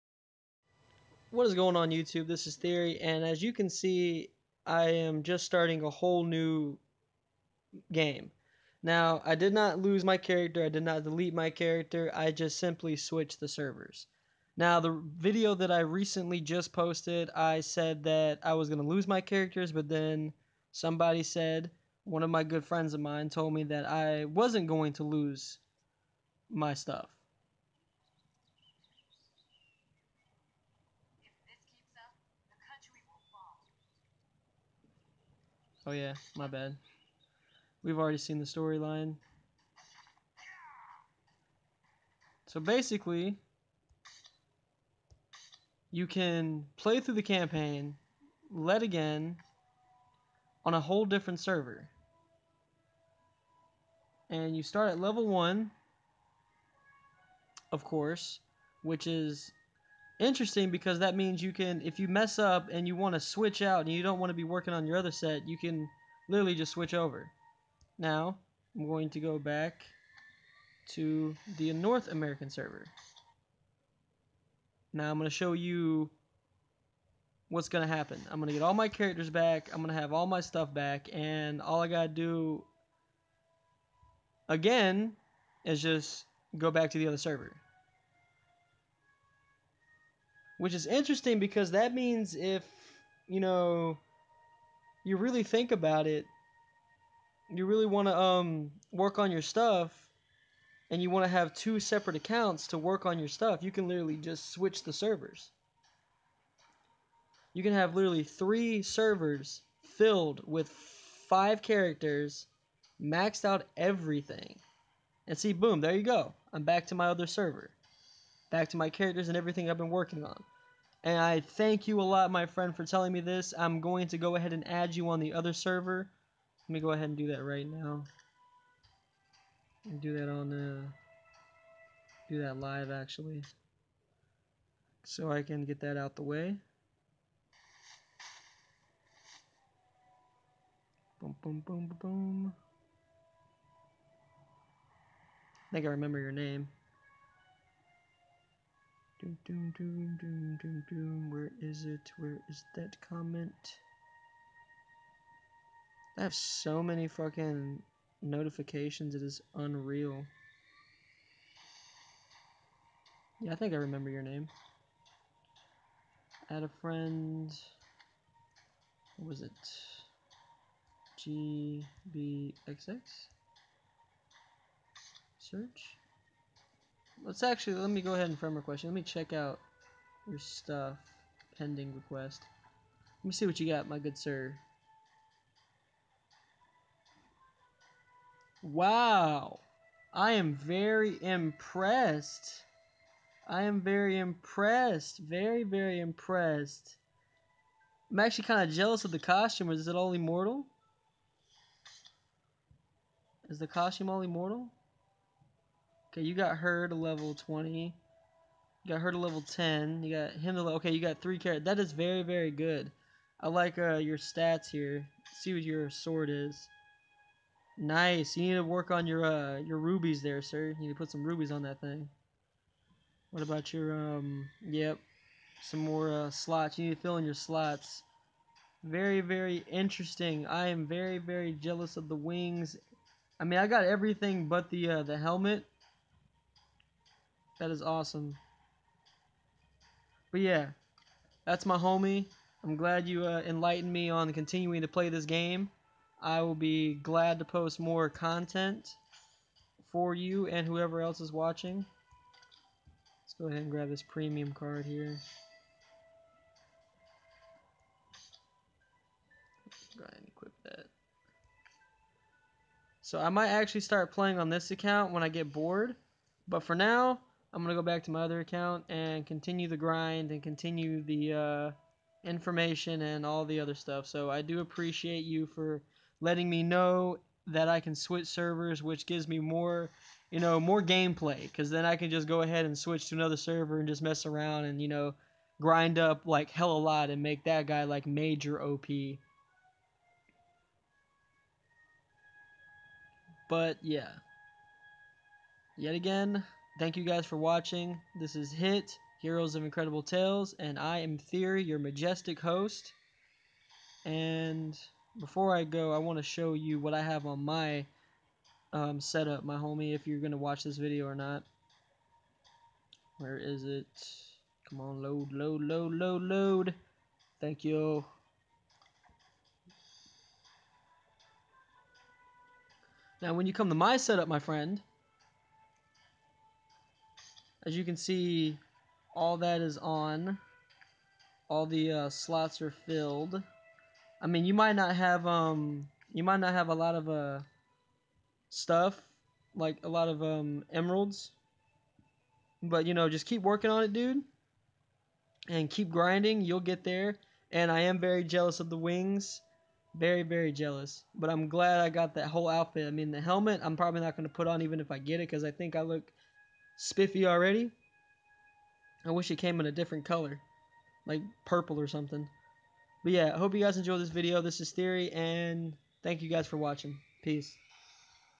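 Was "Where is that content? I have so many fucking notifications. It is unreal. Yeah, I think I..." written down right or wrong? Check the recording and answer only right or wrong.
wrong.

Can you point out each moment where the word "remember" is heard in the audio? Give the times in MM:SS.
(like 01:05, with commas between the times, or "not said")
02:25, 02:43.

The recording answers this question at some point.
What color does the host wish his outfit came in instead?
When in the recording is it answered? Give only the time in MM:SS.
06:01.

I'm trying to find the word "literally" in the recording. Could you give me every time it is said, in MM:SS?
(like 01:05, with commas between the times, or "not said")
01:06, 01:43, 01:47.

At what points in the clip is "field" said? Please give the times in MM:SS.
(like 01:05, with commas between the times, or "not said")
not said.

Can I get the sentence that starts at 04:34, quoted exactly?
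So I do appreciate you for letting me know that I can switch servers, which gives me more, you know, more gameplay.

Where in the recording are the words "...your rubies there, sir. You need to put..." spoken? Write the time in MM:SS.
03:39.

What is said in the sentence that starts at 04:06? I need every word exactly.
I will be glad to post more content for you and whoever else is watching.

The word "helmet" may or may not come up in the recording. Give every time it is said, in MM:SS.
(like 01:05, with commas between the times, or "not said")
03:55, 05:53.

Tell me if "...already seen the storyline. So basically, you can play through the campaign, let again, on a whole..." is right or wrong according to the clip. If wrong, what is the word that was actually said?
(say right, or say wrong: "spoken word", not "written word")
right.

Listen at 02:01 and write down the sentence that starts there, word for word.
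And I thank you a lot, my friend, for telling me this.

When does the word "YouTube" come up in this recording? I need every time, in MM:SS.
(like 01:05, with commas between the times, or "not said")
00:01.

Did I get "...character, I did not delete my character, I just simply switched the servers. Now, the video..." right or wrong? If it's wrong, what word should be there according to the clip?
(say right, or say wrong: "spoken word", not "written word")
right.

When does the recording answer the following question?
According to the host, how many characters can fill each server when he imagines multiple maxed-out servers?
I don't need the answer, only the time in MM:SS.
01:51.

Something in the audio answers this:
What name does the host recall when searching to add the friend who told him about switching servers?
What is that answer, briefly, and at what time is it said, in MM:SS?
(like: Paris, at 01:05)
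GBXX, at 02:51.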